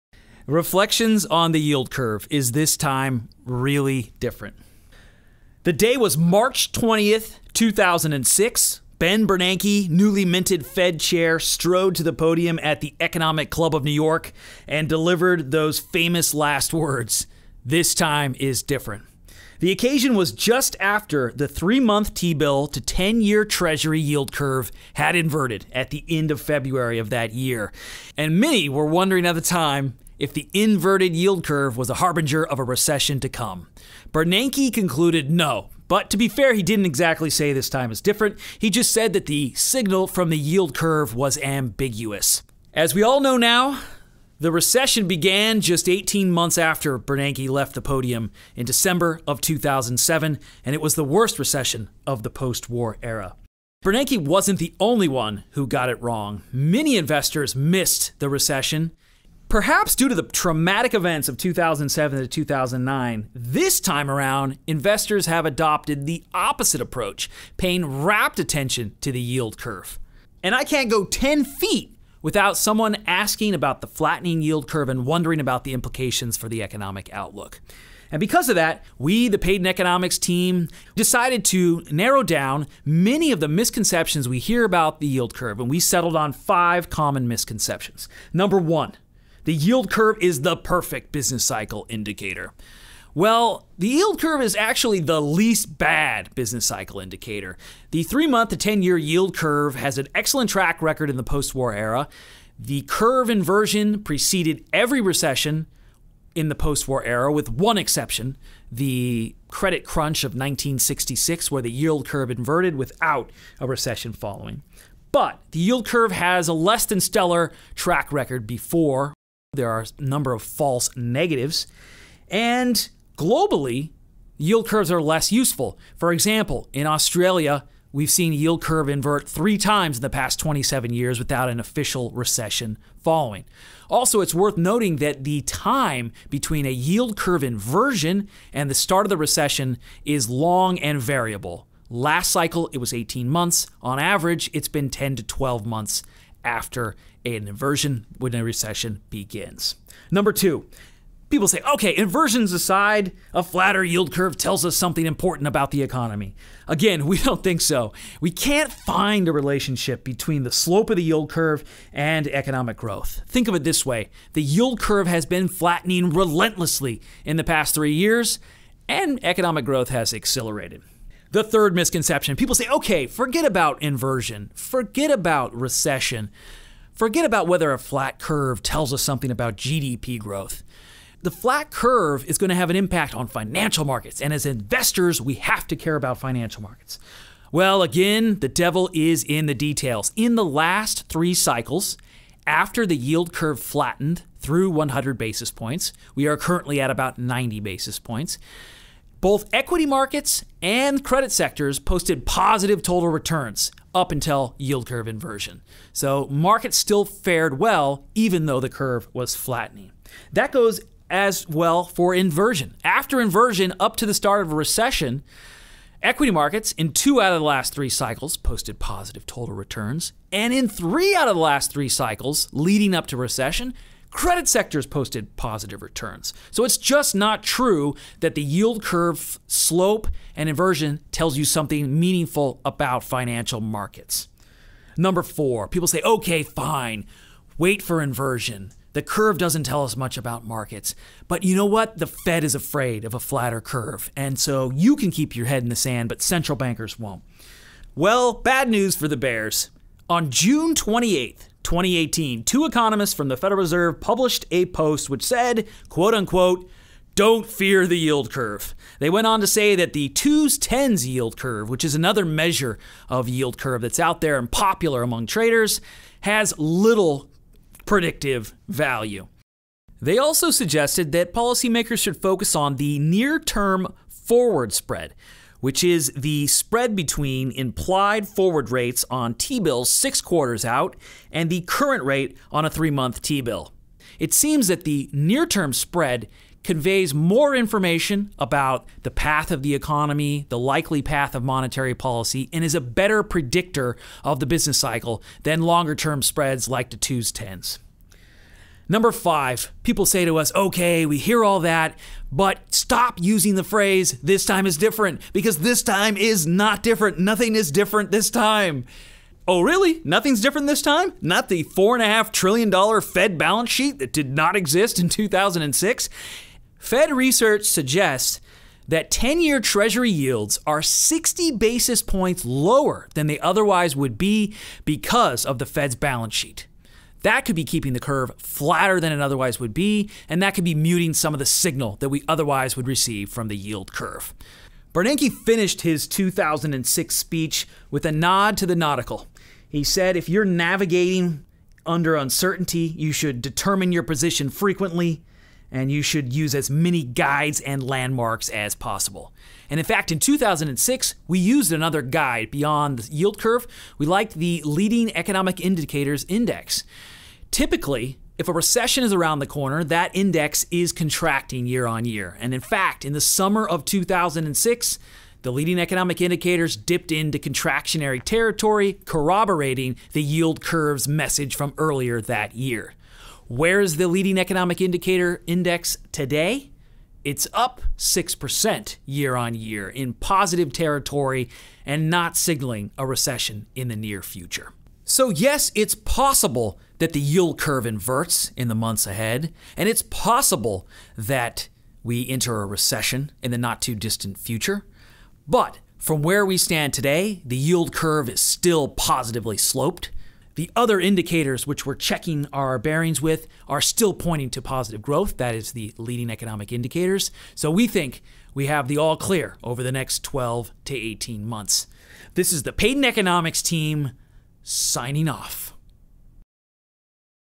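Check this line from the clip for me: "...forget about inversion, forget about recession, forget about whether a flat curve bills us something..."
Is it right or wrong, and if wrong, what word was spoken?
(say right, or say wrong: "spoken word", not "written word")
wrong: "tells", not "bills".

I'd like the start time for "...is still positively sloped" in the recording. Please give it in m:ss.
6:38.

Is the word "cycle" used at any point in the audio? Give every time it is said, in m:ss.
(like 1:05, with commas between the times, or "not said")
1:31, 1:36, 2:22, 3:11, 3:37, 3:41, 4:54.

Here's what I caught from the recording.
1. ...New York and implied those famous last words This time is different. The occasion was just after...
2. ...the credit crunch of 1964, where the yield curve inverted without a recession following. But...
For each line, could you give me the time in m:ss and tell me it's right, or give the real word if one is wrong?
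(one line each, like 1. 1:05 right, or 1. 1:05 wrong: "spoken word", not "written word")
1. 0:13 wrong: "delivered", not "implied"
2. 1:48 wrong: "1966", not "1964".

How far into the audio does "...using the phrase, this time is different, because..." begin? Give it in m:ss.
5:03.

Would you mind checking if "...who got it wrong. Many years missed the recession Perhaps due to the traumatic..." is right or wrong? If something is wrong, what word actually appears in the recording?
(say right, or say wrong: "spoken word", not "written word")
wrong: "investors", not "years".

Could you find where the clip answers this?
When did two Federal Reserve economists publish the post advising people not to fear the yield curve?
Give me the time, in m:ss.
4:10.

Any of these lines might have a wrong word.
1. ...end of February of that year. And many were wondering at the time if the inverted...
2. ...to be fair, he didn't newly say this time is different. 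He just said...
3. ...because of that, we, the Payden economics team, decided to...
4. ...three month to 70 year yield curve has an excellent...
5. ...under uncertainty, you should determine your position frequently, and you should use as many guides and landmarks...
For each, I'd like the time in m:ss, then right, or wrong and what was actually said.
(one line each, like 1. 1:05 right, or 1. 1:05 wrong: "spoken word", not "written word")
1. 0:26 right
2. 0:36 wrong: "exactly", not "newly"
3. 1:18 right
4. 1:38 wrong: "10", not "70"
5. 5:41 right.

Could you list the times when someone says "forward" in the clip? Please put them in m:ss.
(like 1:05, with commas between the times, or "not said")
4:34, 4:38.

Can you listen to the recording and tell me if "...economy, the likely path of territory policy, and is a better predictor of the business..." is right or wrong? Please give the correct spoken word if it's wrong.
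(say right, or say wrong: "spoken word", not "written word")
wrong: "monetary", not "territory".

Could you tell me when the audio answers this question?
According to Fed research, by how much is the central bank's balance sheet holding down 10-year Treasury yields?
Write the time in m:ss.
5:20.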